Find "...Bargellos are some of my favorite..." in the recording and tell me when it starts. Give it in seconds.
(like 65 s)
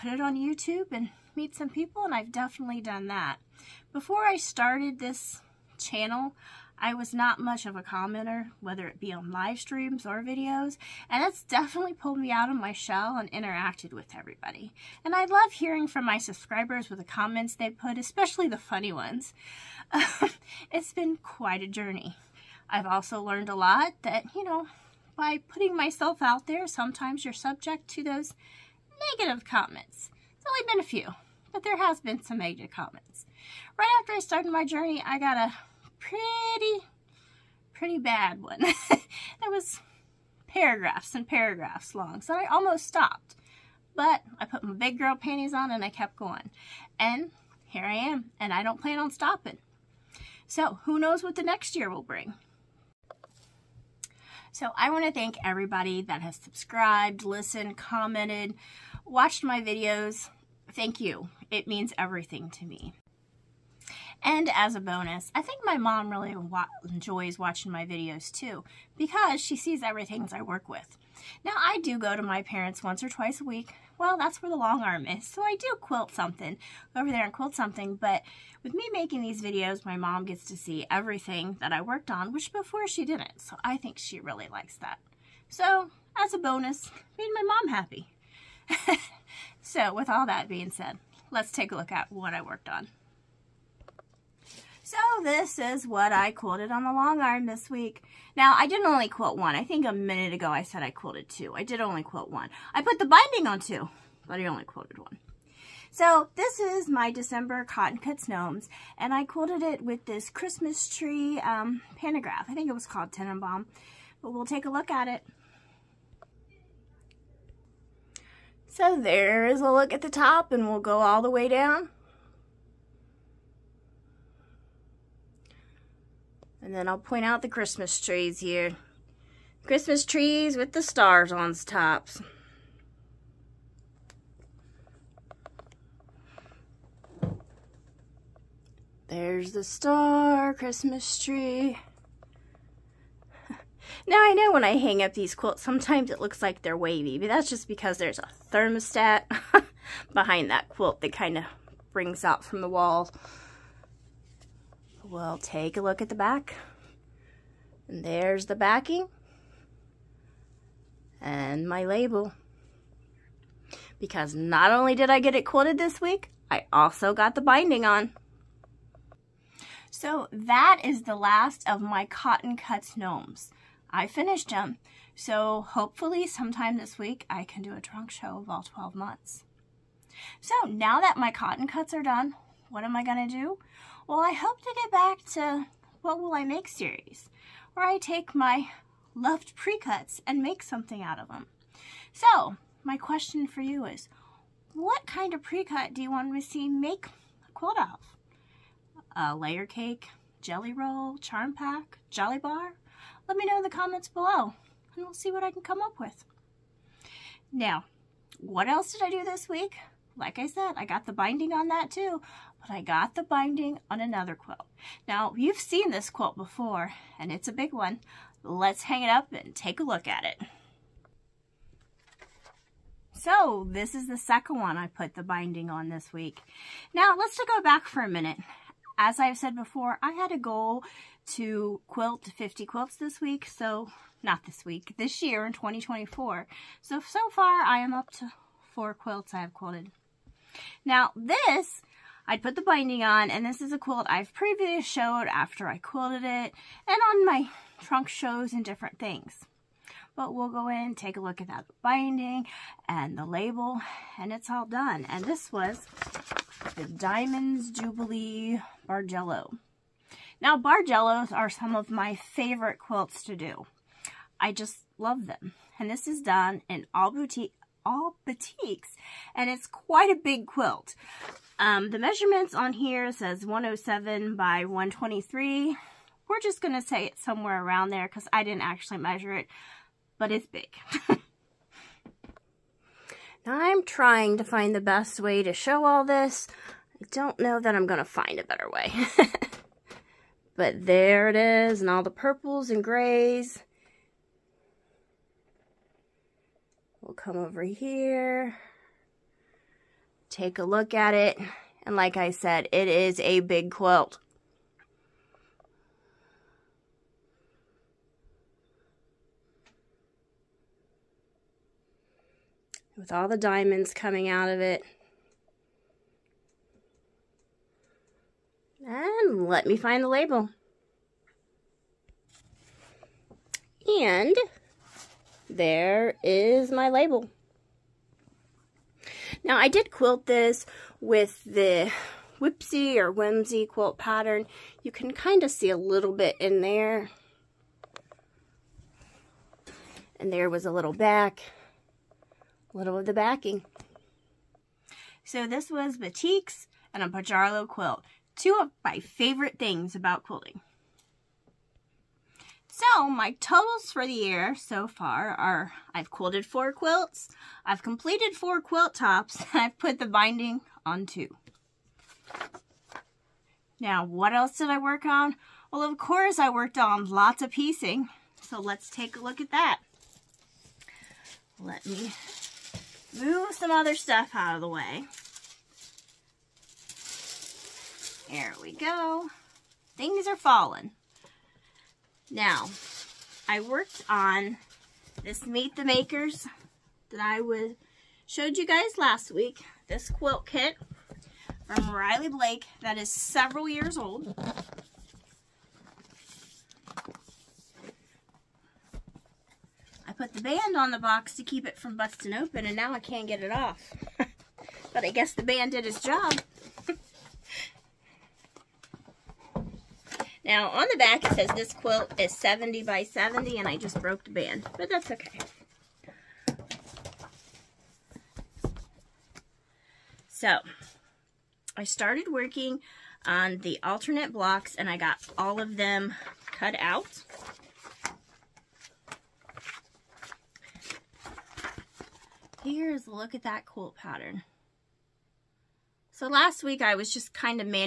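260 s.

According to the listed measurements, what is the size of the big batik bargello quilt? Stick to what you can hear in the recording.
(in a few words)
107 by 123.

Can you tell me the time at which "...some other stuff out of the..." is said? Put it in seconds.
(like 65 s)
373 s.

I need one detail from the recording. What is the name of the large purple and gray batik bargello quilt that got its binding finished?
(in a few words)
Diamonds Jubilee Bargello.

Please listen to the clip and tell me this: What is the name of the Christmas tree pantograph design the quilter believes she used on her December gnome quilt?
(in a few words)
Tannenbaum.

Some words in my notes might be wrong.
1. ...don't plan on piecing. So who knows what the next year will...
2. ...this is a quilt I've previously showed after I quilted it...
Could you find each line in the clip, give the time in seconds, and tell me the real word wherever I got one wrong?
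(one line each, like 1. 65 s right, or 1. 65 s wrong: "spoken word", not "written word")
1. 48 s wrong: "stopping", not "piecing"
2. 243 s right.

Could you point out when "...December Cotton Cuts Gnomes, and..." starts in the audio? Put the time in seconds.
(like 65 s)
107 s.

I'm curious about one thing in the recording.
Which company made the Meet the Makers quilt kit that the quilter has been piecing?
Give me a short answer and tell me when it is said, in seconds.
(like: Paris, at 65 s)
Riley Blake, at 391 s.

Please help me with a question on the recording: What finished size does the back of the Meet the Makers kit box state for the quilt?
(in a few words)
70 by 70.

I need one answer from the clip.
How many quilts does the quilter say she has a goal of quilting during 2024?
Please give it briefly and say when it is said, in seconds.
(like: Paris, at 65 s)
50, at 232 s.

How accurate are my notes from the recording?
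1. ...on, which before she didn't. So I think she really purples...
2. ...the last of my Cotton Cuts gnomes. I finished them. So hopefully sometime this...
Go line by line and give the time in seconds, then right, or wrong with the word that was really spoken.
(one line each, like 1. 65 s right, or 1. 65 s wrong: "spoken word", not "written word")
1. 82 s wrong: "likes", not "purples"
2. 171 s right.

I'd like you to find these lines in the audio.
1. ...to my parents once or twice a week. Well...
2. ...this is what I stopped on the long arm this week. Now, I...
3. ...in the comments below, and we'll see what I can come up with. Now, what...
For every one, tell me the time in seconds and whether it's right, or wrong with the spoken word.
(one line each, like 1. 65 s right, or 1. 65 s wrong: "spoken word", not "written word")
1. 72 s right
2. 95 s wrong: "quilted", not "stopped"
3. 203 s right.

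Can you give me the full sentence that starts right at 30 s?
It's only been a few, but there has been some negative comments.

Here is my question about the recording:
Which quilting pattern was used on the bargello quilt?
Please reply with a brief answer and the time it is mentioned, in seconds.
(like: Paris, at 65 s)
Whimsy, at 333 s.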